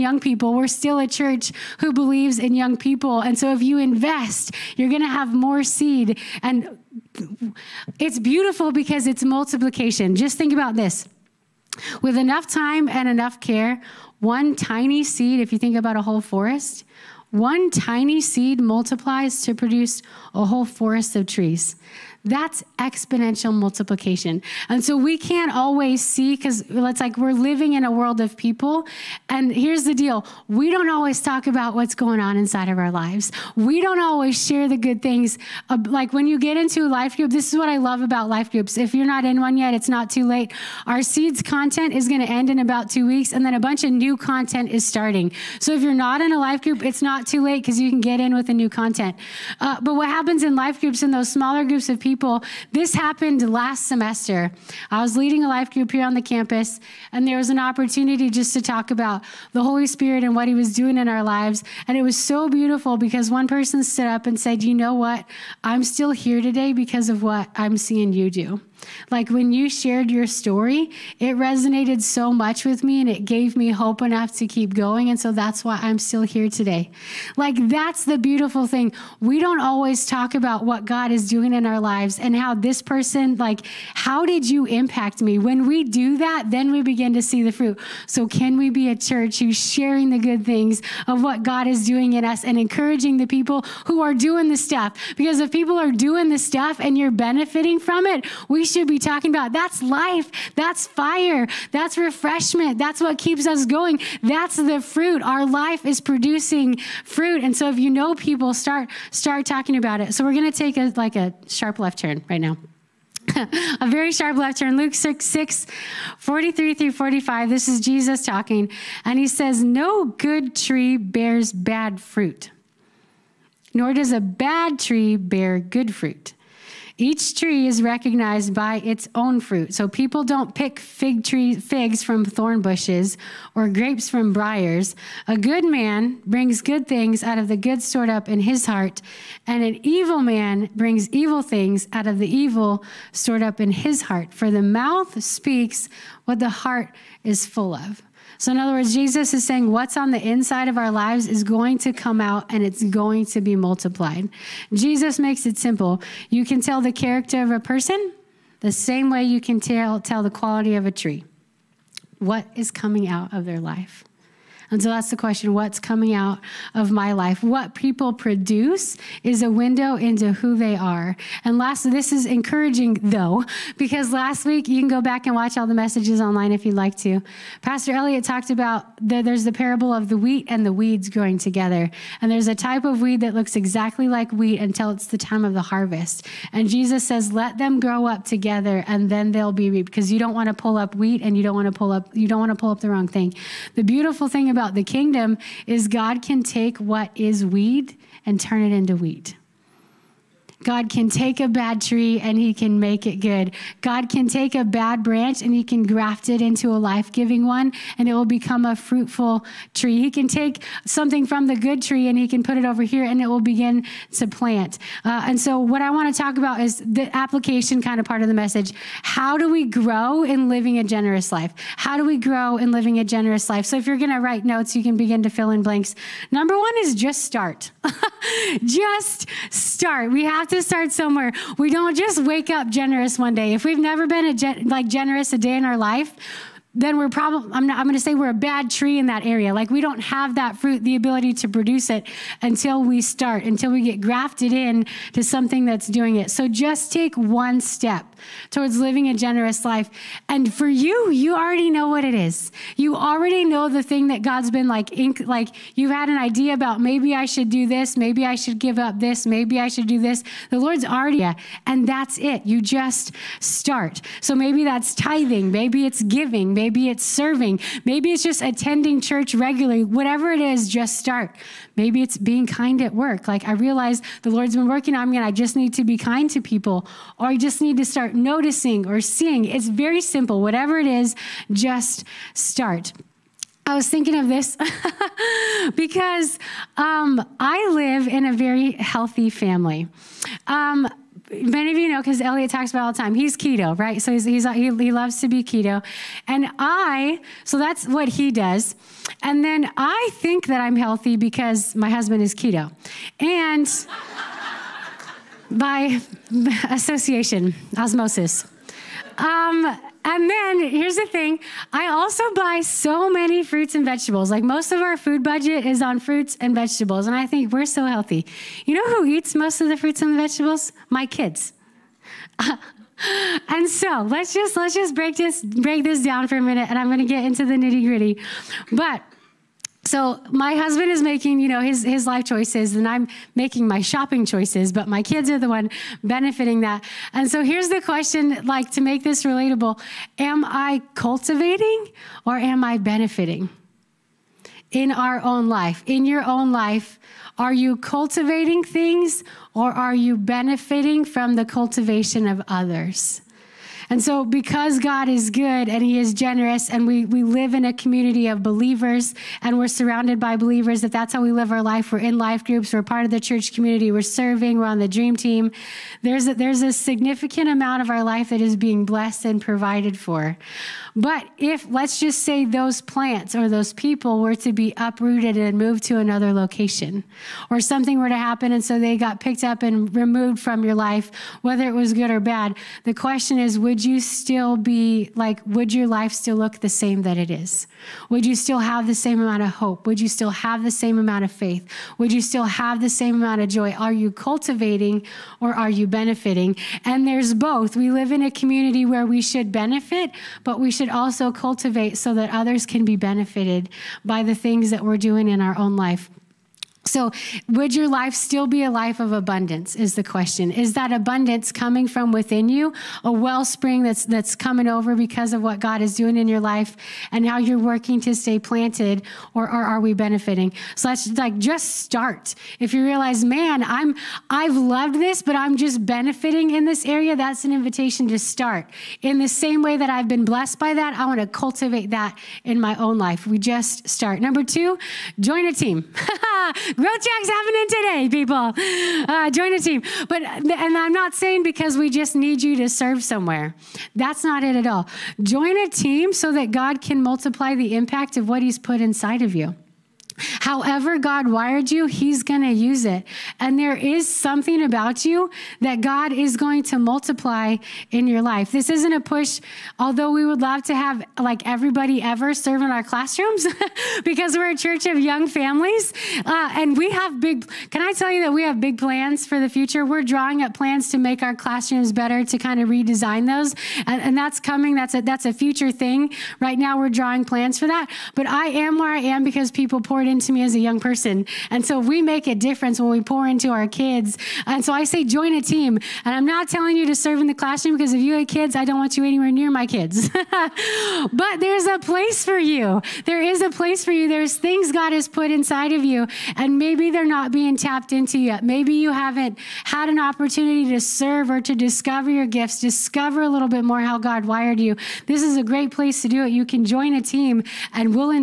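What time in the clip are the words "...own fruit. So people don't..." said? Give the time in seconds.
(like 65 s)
129 s.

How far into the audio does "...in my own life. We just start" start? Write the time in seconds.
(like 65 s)
432 s.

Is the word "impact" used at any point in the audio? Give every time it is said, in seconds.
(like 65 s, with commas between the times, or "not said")
84 s, 447 s.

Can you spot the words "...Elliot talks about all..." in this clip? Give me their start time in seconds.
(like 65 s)
292 s.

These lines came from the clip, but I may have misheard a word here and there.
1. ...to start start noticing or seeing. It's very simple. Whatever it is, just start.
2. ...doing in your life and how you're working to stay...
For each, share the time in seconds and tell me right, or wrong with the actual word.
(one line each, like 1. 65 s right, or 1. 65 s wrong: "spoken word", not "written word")
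1. 277 s right
2. 415 s right.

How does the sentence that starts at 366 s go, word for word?
There's a, there's a significant amount of our life that is being blessed and provided for.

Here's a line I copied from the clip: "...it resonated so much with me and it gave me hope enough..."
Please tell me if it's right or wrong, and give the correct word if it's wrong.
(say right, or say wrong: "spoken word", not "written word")
right.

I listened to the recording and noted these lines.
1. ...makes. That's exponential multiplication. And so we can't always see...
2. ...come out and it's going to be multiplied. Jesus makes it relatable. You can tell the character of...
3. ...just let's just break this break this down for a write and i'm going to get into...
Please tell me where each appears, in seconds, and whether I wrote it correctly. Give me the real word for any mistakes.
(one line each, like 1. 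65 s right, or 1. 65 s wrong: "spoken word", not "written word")
1. 21 s wrong: "trees", not "makes"
2. 151 s wrong: "simple", not "relatable"
3. 324 s wrong: "minute", not "write".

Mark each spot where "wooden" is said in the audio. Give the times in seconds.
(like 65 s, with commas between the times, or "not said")
not said.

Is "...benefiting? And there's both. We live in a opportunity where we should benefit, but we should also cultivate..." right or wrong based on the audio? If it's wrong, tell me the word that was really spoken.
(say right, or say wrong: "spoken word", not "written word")
wrong: "community", not "opportunity".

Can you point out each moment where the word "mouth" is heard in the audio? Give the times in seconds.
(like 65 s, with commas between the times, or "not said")
144 s.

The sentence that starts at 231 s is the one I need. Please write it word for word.
We don't just wake up generous one day.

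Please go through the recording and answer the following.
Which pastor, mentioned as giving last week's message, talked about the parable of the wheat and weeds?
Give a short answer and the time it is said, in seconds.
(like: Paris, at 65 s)
Pastor Elliot, at 177 s.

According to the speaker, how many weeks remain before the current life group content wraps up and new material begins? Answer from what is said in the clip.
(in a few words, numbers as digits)
2.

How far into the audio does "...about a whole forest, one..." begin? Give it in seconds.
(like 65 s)
15 s.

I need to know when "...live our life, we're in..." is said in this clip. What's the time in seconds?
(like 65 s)
361 s.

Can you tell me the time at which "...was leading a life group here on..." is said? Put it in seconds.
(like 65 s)
55 s.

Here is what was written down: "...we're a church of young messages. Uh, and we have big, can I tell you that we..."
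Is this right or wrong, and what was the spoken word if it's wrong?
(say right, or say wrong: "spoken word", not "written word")
wrong: "families", not "messages".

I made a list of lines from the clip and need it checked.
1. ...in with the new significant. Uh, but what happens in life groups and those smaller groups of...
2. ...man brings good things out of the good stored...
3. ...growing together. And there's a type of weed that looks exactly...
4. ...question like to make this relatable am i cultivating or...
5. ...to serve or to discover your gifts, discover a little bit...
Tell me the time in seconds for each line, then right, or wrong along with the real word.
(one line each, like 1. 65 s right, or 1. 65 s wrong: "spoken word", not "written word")
1. 48 s wrong: "content", not "significant"
2. 135 s right
3. 181 s right
4. 337 s right
5. 500 s right.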